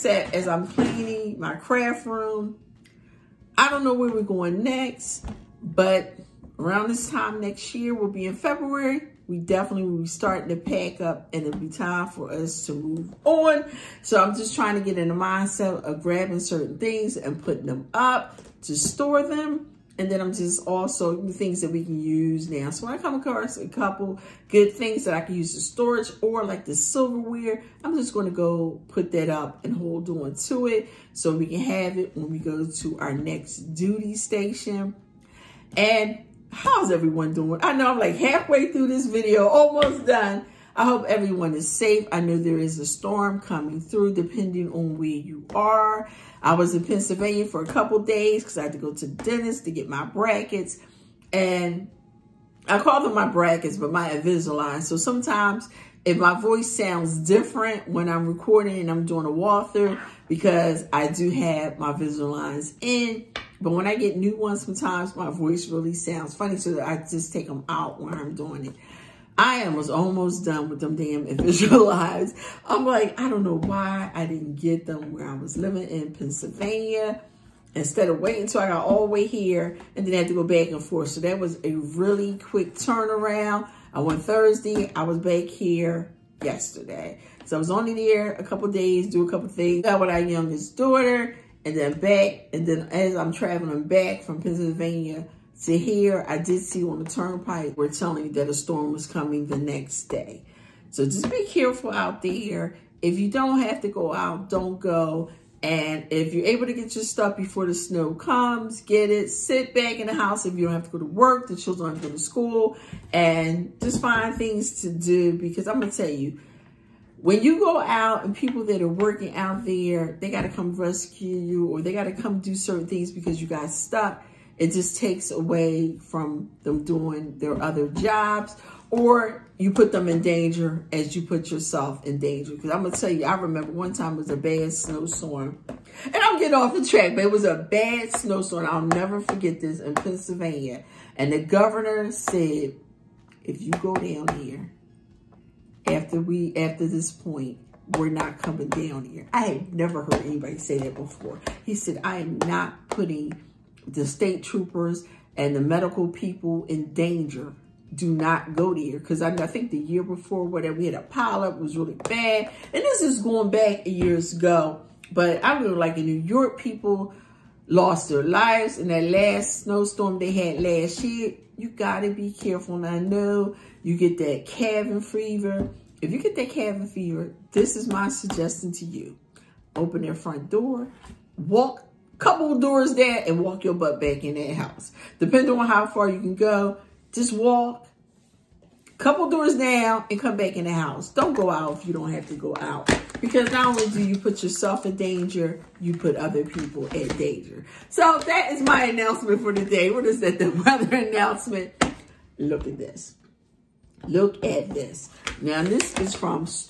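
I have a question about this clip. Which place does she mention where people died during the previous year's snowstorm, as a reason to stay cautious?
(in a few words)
New York.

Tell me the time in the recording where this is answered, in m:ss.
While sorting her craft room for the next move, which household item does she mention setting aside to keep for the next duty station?
0:26.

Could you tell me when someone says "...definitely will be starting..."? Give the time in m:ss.
0:09.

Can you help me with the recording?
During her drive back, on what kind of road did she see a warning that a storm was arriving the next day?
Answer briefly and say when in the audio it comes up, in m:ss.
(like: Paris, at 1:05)
the turnpike, at 1:37.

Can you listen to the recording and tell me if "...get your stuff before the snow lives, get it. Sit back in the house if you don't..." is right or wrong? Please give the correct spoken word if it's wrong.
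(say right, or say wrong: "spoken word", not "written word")
wrong: "comes", not "lives".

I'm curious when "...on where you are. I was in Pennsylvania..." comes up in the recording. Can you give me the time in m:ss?
0:44.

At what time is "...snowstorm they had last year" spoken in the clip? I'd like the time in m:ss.
2:49.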